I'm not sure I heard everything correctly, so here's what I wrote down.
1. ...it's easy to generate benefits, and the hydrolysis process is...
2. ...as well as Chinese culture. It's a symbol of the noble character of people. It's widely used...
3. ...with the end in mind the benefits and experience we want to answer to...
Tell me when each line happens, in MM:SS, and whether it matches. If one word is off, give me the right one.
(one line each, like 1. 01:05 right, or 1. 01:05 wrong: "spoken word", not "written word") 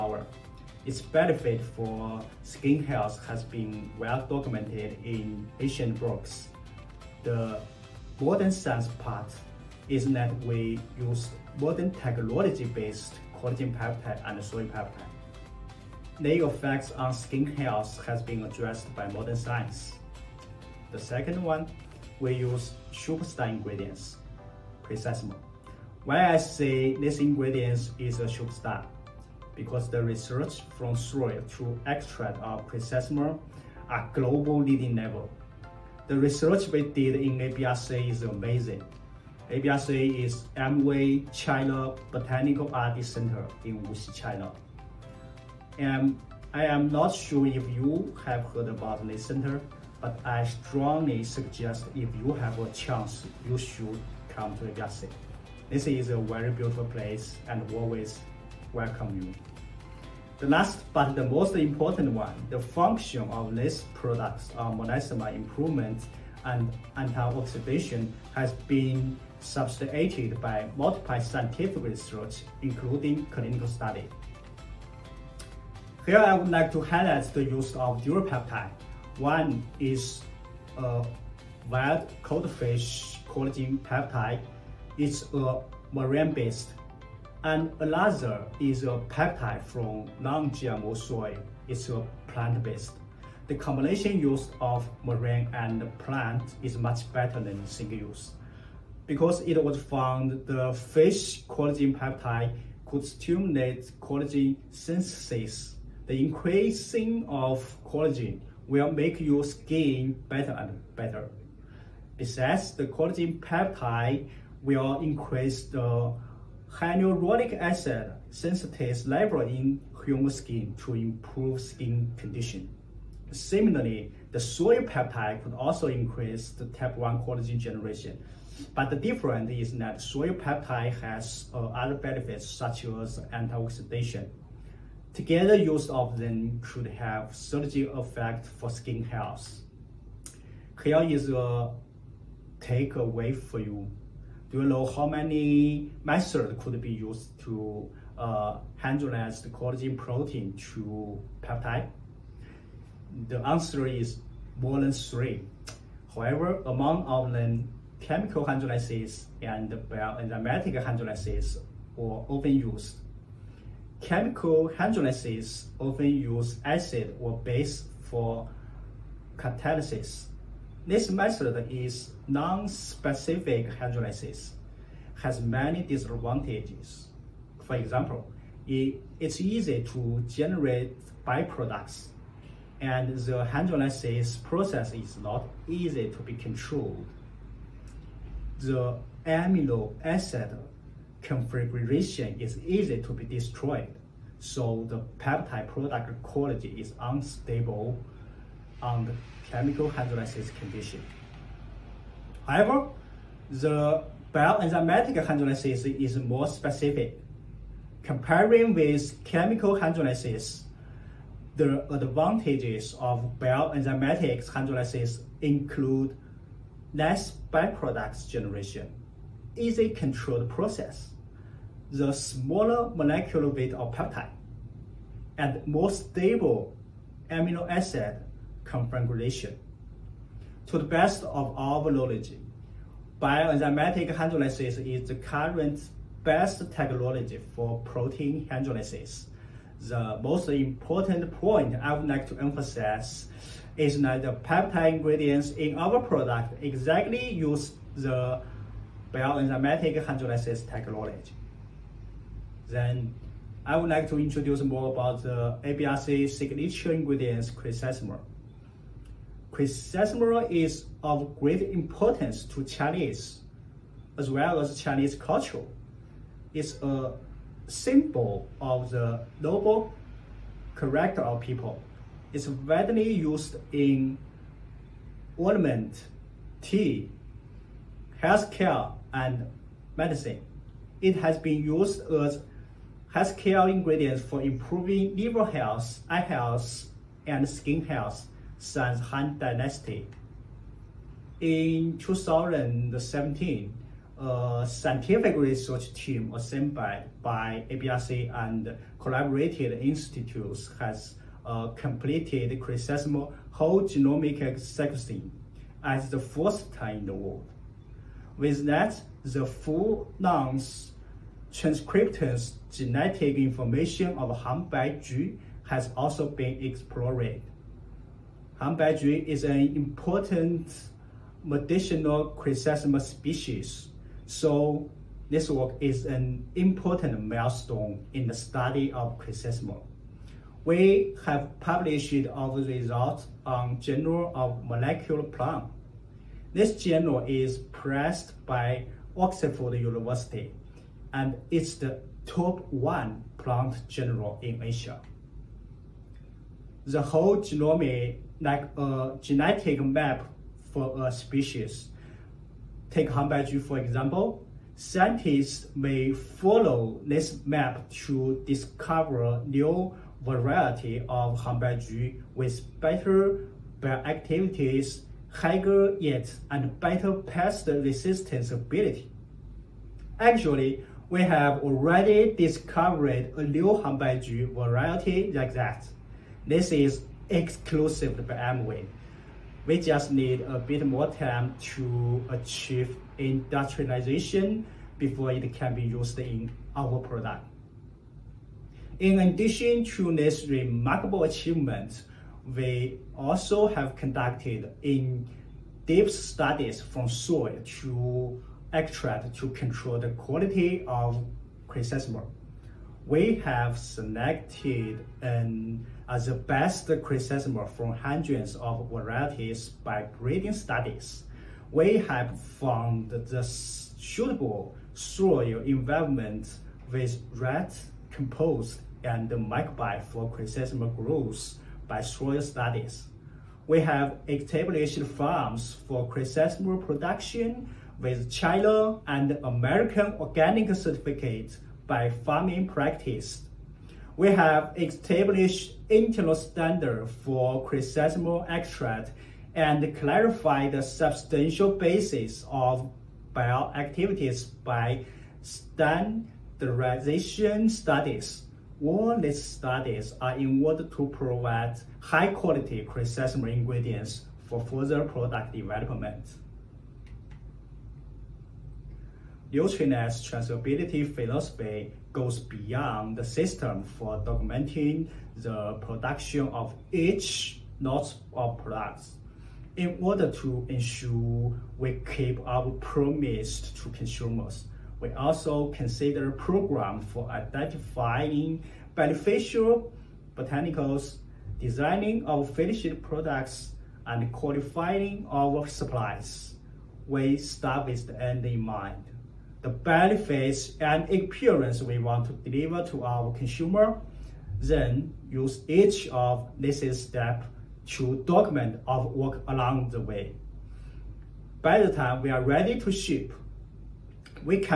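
1. 02:59 wrong: "byproducts", not "benefits"
2. 04:24 right
3. 08:07 wrong: "deliver", not "answer".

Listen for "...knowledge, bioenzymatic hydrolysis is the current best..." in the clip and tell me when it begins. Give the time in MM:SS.
03:51.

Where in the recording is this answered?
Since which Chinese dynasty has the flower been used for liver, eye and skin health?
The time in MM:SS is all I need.
04:48.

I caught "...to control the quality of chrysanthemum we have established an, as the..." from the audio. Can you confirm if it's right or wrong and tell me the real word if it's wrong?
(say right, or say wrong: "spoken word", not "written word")
wrong: "selected", not "established".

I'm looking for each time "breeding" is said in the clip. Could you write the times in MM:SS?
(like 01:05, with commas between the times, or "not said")
06:50.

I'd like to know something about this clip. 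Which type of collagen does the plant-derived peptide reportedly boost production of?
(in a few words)
Type 1.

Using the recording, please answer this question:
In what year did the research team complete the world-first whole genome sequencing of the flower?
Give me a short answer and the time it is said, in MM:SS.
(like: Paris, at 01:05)
2017, at 04:51.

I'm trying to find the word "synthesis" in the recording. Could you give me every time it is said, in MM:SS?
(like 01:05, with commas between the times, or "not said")
01:44.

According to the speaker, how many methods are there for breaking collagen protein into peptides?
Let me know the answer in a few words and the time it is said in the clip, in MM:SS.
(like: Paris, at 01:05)
More than 3, at 02:34.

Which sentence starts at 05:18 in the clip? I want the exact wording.
Hanbaiju is an important medicinal chrysanthemum species.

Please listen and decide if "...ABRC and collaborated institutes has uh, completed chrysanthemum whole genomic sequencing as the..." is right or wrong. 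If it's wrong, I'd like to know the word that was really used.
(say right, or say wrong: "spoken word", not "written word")
right.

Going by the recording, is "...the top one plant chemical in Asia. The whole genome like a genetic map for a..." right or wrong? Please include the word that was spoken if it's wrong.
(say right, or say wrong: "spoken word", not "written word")
wrong: "general", not "chemical".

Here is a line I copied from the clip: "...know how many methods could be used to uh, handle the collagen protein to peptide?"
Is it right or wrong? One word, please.
right.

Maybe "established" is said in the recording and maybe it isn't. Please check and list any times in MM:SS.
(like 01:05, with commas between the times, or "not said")
07:04, 07:14.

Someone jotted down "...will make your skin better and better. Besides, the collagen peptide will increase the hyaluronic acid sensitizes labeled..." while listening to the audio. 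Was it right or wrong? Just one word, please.
right.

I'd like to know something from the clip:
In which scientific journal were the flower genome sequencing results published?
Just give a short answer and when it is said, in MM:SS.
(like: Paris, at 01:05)
Molecular Plant, at 05:33.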